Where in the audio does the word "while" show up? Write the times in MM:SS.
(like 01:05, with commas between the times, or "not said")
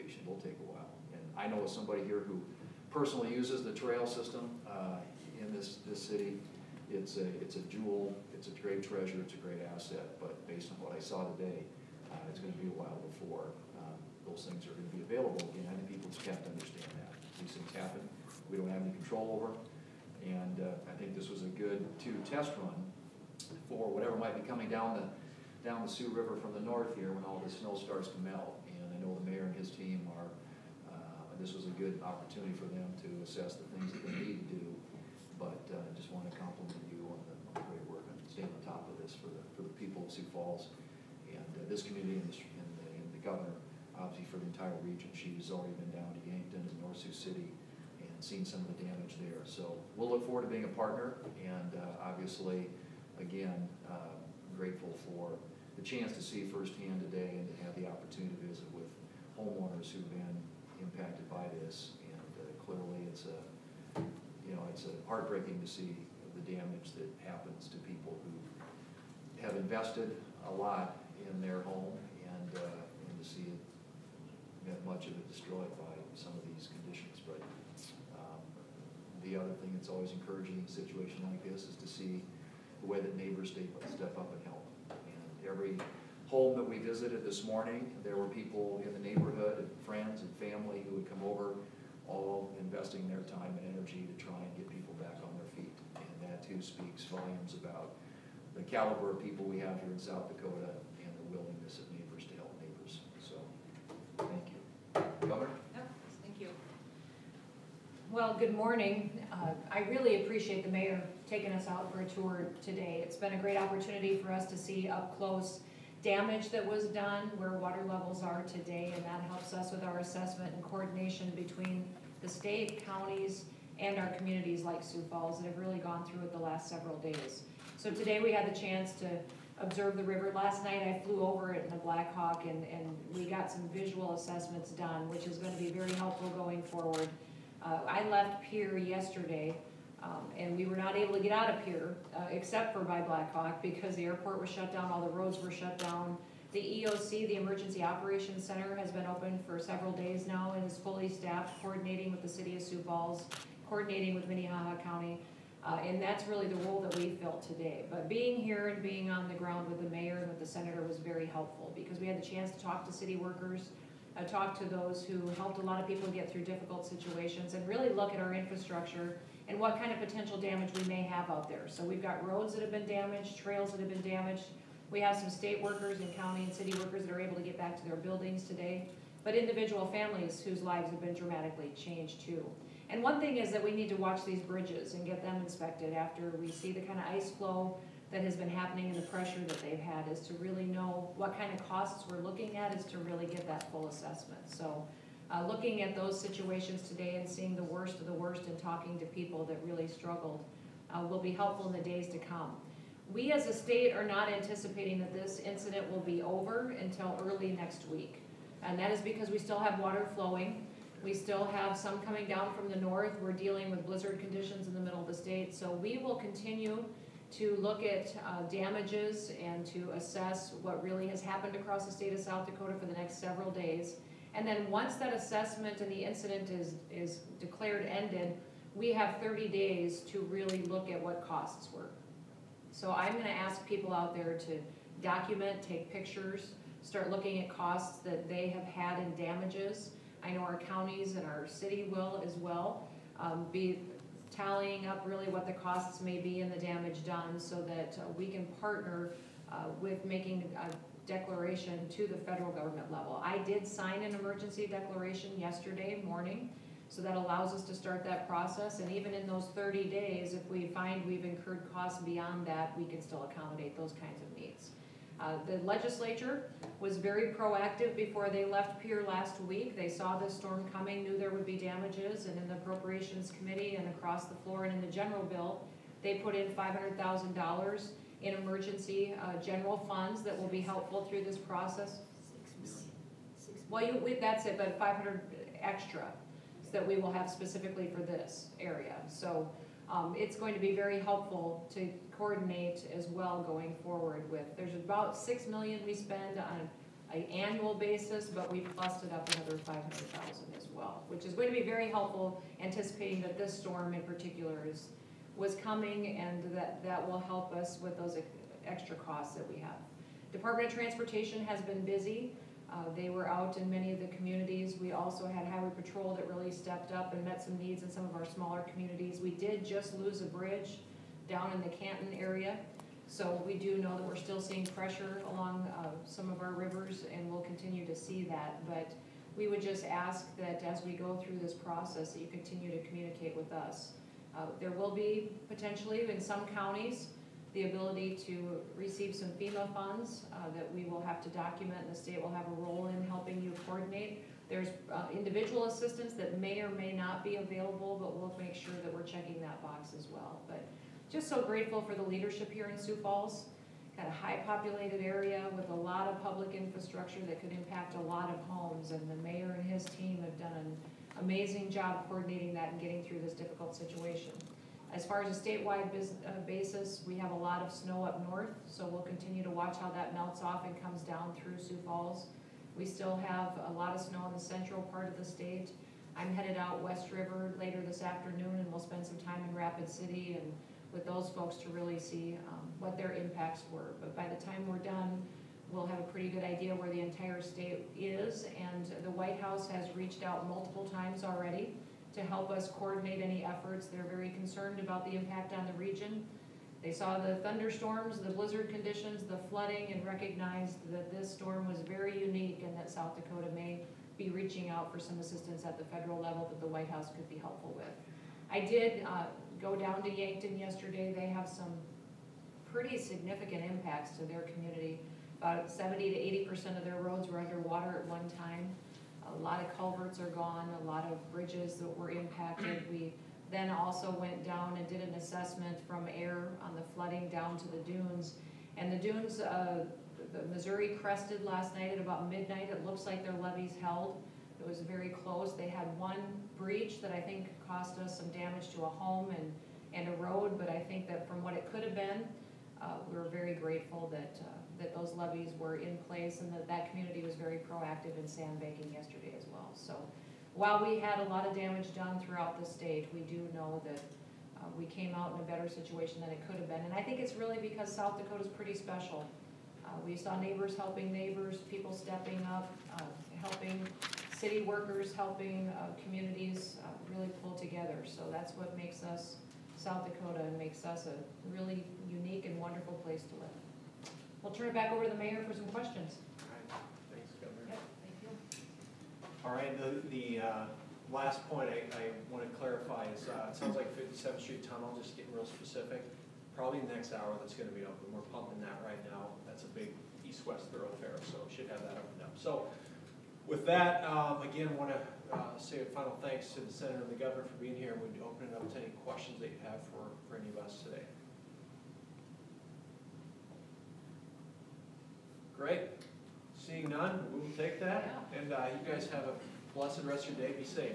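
00:00, 00:12, 07:30.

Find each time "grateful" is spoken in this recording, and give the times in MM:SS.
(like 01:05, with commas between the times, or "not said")
00:54, 05:51, 07:23.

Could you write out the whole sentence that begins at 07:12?
It looks like their levees held.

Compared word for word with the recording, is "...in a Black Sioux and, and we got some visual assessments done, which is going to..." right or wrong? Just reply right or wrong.
wrong.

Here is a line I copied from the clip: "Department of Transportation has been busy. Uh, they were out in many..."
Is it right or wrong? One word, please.
right.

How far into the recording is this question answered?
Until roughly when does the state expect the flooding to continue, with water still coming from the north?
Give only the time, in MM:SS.
03:27.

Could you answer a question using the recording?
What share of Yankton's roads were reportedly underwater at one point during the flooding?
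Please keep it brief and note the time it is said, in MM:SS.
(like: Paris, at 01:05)
70 to 80 percent, at 06:55.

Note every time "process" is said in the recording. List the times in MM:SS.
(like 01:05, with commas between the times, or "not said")
04:18, 04:41, 05:31.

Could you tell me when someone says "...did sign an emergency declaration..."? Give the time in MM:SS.
04:13.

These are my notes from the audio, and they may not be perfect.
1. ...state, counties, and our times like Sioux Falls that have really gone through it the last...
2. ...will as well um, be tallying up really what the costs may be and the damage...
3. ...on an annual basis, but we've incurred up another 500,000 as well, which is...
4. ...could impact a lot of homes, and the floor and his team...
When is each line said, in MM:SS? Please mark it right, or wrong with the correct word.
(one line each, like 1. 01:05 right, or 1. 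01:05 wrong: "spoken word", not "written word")
1. 02:02 wrong: "communities", not "times"
2. 04:01 right
3. 04:56 wrong: "busted", not "incurred"
4. 05:57 wrong: "mayor", not "floor".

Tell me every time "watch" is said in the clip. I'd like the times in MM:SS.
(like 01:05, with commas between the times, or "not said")
03:03, 06:09.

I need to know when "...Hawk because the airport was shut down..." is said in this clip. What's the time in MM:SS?
02:23.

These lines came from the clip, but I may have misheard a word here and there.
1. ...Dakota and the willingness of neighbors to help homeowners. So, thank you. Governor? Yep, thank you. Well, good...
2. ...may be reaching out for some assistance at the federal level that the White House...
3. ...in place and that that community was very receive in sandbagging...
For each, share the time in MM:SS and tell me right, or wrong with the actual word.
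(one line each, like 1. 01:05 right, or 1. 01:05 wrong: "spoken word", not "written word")
1. 01:40 wrong: "neighbors", not "homeowners"
2. 06:43 right
3. 07:25 wrong: "proactive", not "receive".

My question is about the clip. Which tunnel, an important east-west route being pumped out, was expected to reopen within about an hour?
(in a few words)
57th Street Tunnel.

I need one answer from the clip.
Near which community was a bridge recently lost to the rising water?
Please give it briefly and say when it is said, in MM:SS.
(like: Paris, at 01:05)
Canton, at 05:21.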